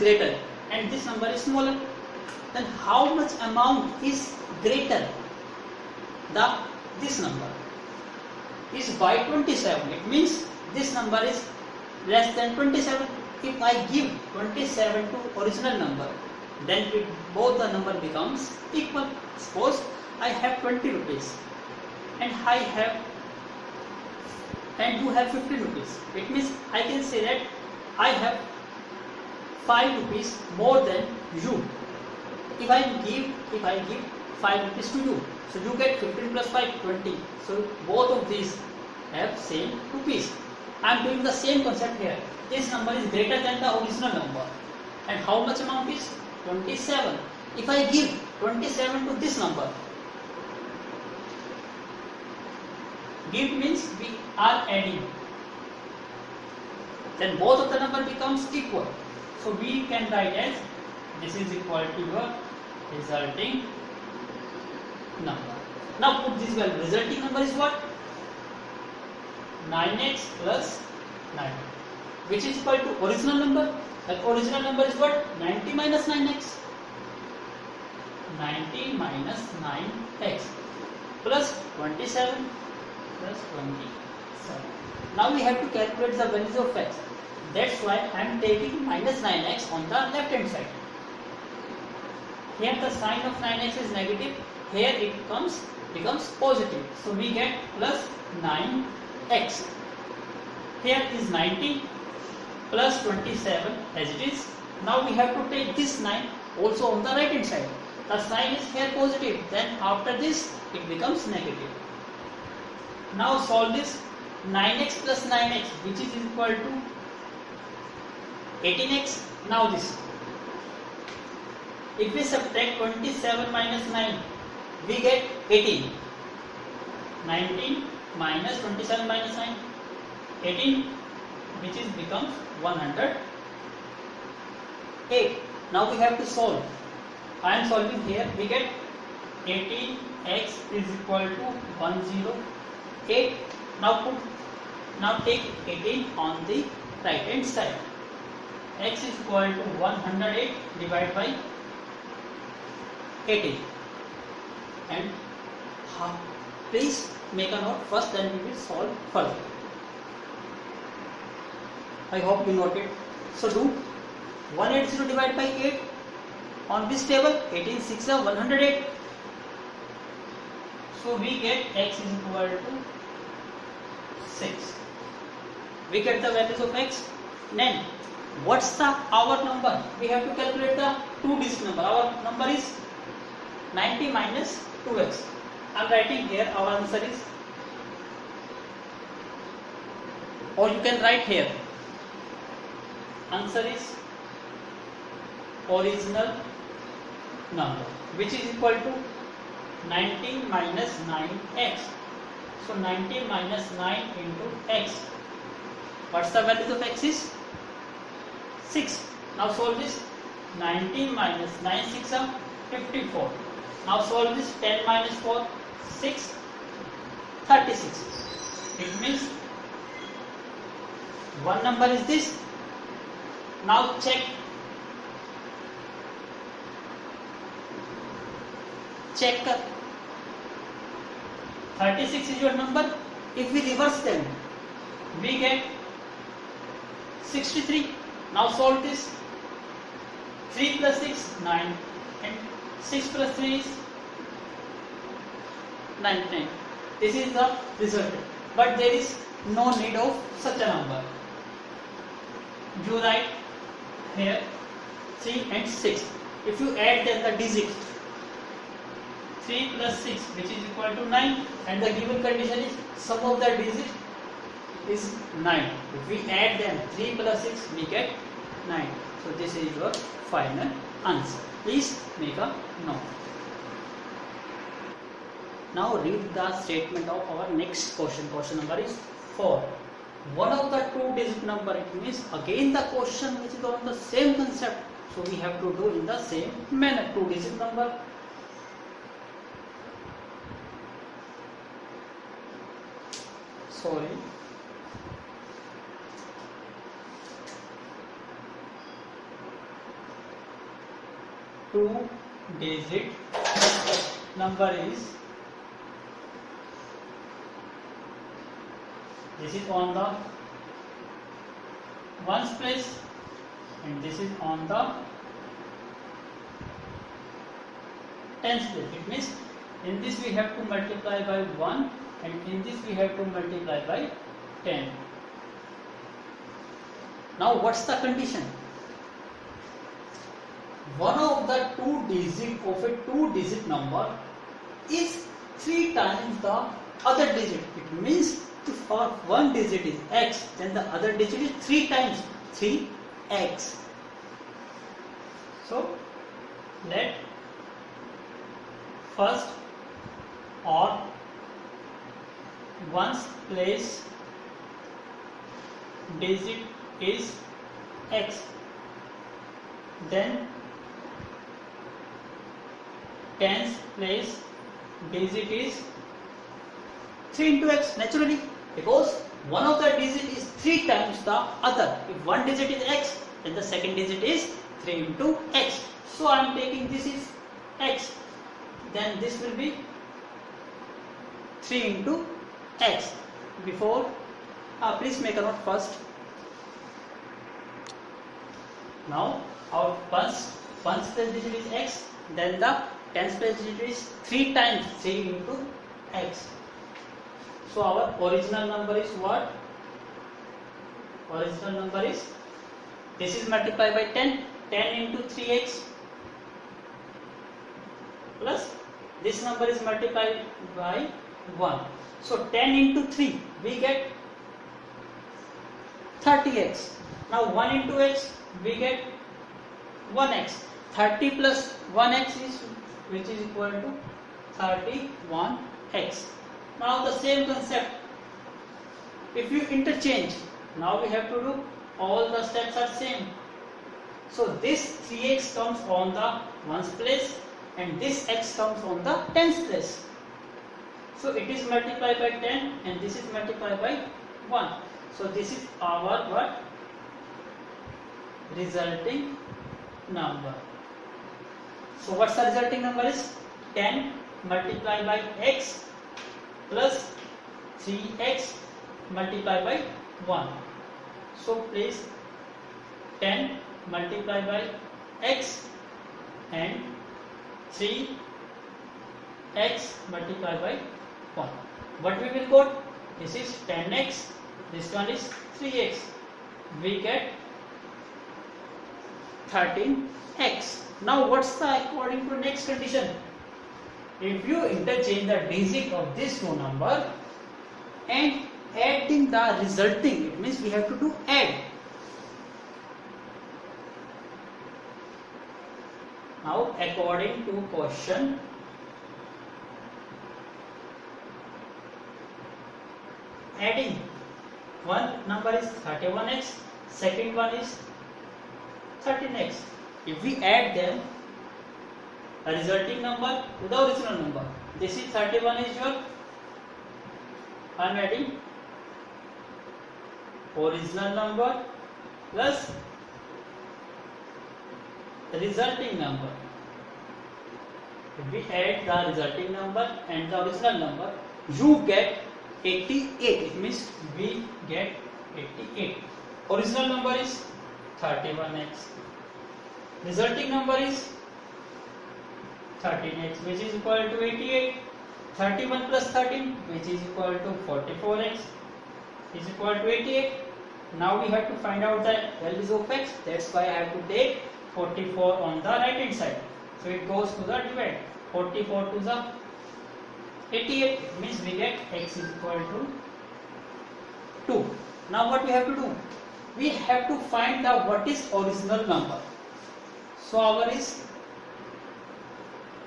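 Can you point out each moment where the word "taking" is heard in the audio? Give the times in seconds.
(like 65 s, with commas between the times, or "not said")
88 s, 376 s.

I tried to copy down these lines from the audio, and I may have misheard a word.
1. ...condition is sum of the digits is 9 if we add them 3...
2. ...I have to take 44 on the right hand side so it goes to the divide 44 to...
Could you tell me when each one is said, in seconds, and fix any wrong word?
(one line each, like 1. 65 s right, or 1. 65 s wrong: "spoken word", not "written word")
1. 262 s right
2. 553 s right.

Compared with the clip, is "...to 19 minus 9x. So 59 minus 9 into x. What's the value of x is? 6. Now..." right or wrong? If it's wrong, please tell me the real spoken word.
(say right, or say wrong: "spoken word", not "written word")
wrong: "19", not "59".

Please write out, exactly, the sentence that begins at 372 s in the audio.
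If one digit is x, then the second digit is 3 into x.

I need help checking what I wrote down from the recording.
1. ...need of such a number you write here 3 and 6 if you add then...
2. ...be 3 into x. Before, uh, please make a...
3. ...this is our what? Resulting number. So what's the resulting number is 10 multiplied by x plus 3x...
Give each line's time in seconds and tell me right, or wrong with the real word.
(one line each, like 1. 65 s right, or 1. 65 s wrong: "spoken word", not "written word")
1. 249 s right
2. 379 s right
3. 445 s right.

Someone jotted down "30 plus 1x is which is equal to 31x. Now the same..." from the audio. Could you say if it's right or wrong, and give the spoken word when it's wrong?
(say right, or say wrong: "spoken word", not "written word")
right.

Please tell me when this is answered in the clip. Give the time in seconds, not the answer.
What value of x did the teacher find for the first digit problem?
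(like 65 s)
171 s.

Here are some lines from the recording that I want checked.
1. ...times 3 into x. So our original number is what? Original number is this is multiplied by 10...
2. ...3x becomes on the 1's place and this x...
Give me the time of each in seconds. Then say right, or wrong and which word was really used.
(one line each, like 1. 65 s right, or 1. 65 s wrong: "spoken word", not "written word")
1. 394 s right
2. 435 s wrong: "comes", not "becomes".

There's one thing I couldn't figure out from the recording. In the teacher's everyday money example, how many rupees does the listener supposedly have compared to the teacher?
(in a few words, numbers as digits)
15 rupees.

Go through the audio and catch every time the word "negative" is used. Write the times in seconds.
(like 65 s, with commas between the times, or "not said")
94 s, 111 s.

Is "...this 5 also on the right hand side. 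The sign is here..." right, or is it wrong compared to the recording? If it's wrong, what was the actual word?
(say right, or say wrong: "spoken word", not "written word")
wrong: "9", not "5".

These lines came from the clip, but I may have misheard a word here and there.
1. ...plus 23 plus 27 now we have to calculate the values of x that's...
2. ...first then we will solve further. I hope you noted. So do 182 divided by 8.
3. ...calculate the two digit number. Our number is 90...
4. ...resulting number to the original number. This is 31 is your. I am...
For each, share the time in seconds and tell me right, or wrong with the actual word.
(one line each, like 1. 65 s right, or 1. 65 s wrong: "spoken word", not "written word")
1. 81 s wrong: "27", not "23"
2. 157 s wrong: "180", not "182"
3. 180 s right
4. 512 s right.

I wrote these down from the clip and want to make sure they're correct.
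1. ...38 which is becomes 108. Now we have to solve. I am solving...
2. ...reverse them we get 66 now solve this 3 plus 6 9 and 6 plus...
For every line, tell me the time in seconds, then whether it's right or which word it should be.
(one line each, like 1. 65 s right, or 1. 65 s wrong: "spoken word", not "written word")
1. 130 s wrong: "18", not "38"
2. 233 s wrong: "63", not "66".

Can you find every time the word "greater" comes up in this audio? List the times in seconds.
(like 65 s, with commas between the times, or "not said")
4 s, 43 s.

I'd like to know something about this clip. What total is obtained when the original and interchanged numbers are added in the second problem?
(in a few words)
88.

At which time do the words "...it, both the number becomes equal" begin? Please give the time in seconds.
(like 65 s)
16 s.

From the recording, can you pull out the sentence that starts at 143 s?
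Now put now take 18 on the right hand side.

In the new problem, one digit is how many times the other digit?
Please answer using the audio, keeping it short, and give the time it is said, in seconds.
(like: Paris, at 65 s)
three times, at 335 s.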